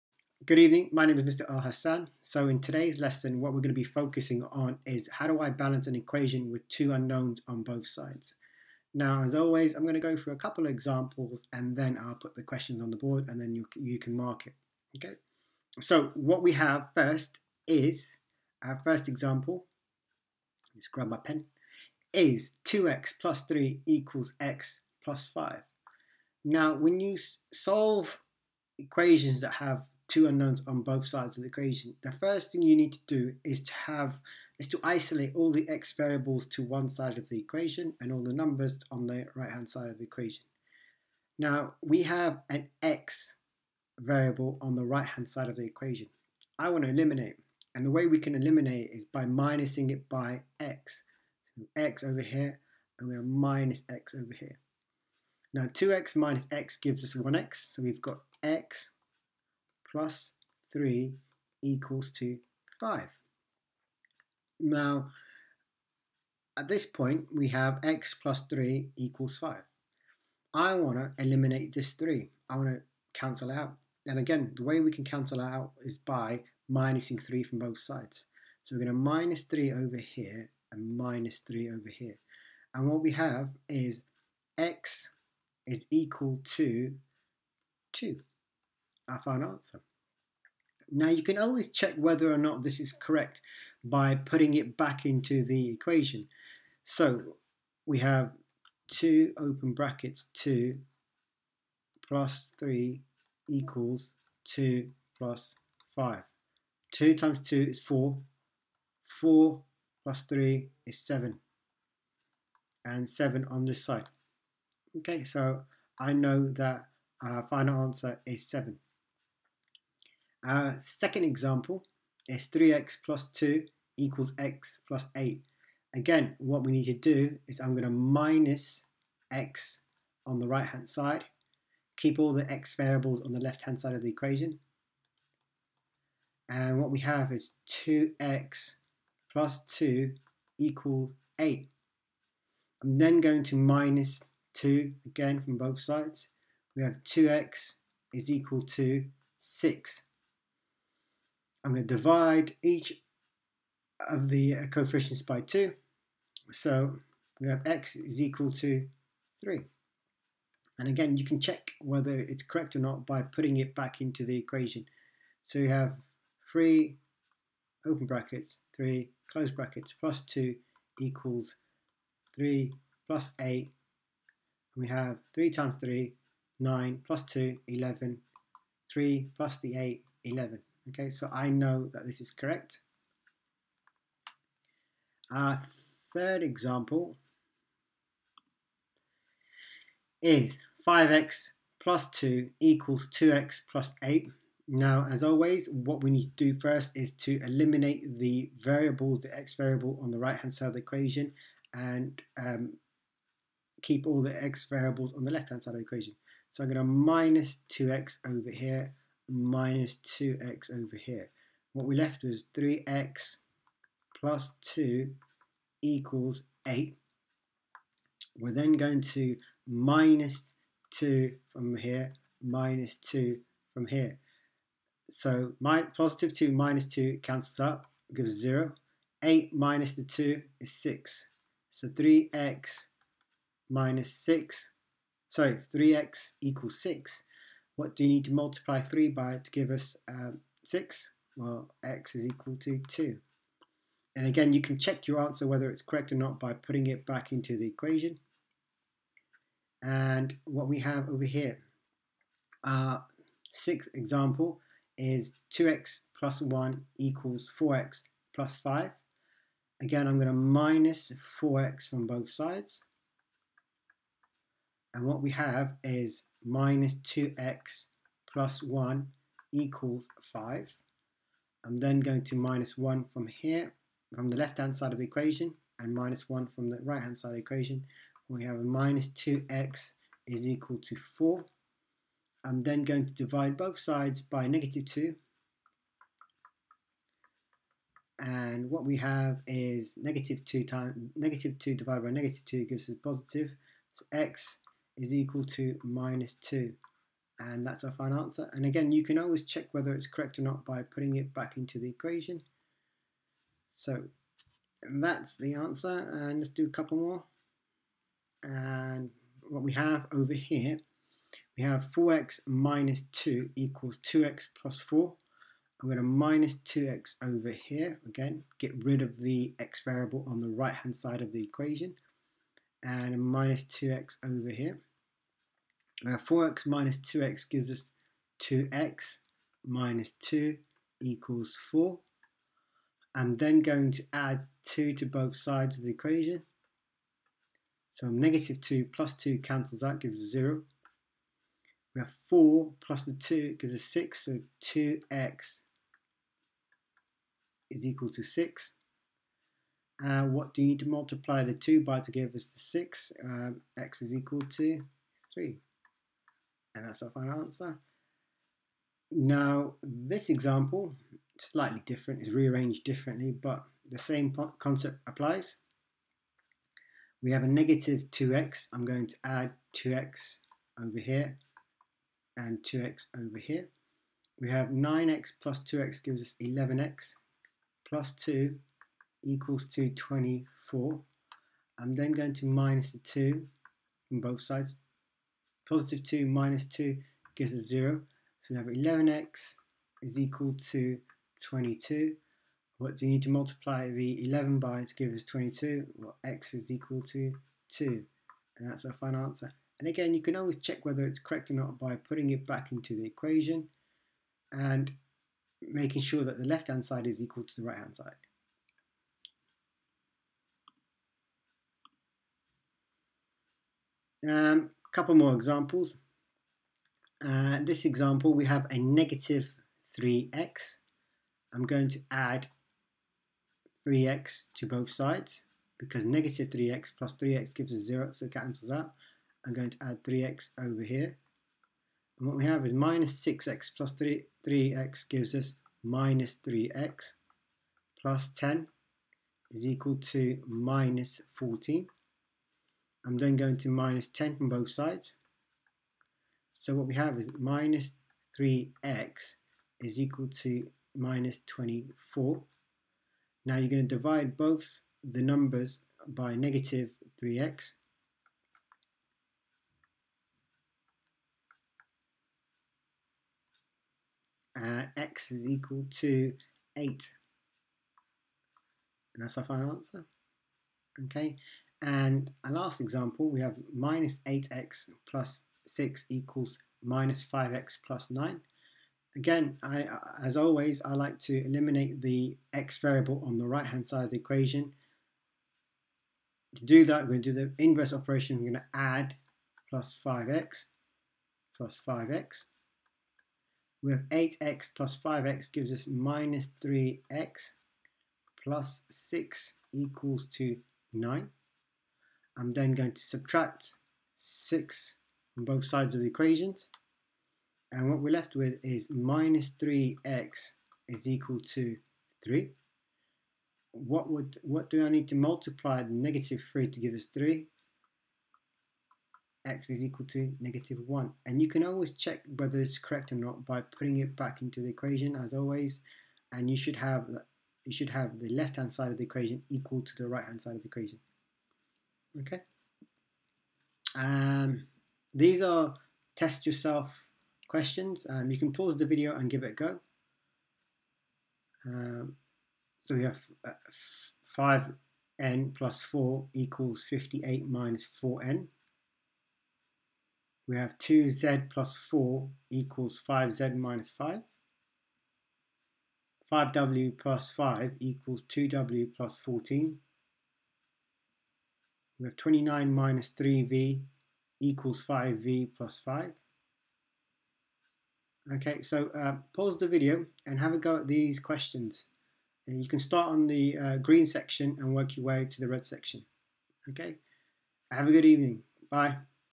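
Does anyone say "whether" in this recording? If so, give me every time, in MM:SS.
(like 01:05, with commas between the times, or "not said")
01:31, 02:41, 04:05, 04:59, 06:40, 08:42.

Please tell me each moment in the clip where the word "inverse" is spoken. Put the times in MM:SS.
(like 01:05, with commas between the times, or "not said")
08:07.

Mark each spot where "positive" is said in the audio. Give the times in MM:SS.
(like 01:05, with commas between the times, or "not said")
03:45, 04:53, 06:25.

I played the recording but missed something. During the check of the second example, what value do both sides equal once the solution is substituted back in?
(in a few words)
11.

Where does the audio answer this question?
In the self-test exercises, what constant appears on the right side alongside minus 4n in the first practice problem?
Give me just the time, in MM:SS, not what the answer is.
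09:06.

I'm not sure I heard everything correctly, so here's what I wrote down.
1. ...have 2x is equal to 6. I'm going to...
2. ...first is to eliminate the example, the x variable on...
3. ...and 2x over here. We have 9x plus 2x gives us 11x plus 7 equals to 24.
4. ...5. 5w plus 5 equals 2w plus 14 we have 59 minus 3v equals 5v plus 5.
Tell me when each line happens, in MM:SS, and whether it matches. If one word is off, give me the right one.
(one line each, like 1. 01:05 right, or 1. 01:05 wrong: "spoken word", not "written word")
1. 02:26 right
2. 03:16 wrong: "variable", not "example"
3. 06:12 wrong: "2", not "7"
4. 09:13 wrong: "29", not "59".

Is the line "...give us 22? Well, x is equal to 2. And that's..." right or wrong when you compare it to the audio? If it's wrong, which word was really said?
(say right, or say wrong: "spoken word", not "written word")
right.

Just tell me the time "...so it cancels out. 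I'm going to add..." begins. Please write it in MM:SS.
07:08.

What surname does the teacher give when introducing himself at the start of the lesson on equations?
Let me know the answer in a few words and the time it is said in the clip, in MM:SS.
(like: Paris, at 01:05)
Elhassan, at 00:01.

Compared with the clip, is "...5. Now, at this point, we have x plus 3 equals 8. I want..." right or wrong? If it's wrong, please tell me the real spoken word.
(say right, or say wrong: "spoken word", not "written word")
wrong: "5", not "8".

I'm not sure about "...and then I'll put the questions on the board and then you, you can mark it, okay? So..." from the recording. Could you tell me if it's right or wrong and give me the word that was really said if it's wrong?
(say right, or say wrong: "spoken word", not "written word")
right.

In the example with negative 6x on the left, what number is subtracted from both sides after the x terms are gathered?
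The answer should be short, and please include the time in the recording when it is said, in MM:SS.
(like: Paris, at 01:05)
10, at 07:23.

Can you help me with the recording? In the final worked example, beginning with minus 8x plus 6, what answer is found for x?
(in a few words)
-1.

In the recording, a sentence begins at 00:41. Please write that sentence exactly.
Now we have an x variable on the right hand side of the equation.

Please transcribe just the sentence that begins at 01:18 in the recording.
So we're going to minus 3 over here and minus 3 over here.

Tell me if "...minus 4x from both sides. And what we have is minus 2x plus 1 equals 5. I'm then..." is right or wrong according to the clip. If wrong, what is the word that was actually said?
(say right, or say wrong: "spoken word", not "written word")
right.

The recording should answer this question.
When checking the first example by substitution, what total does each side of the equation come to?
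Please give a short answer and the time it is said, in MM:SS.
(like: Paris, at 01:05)
7, at 01:52.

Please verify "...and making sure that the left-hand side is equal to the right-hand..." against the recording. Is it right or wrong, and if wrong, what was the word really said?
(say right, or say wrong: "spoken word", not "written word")
right.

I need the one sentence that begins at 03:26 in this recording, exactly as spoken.
So I'm going to minus 2x over here minus 2x over here.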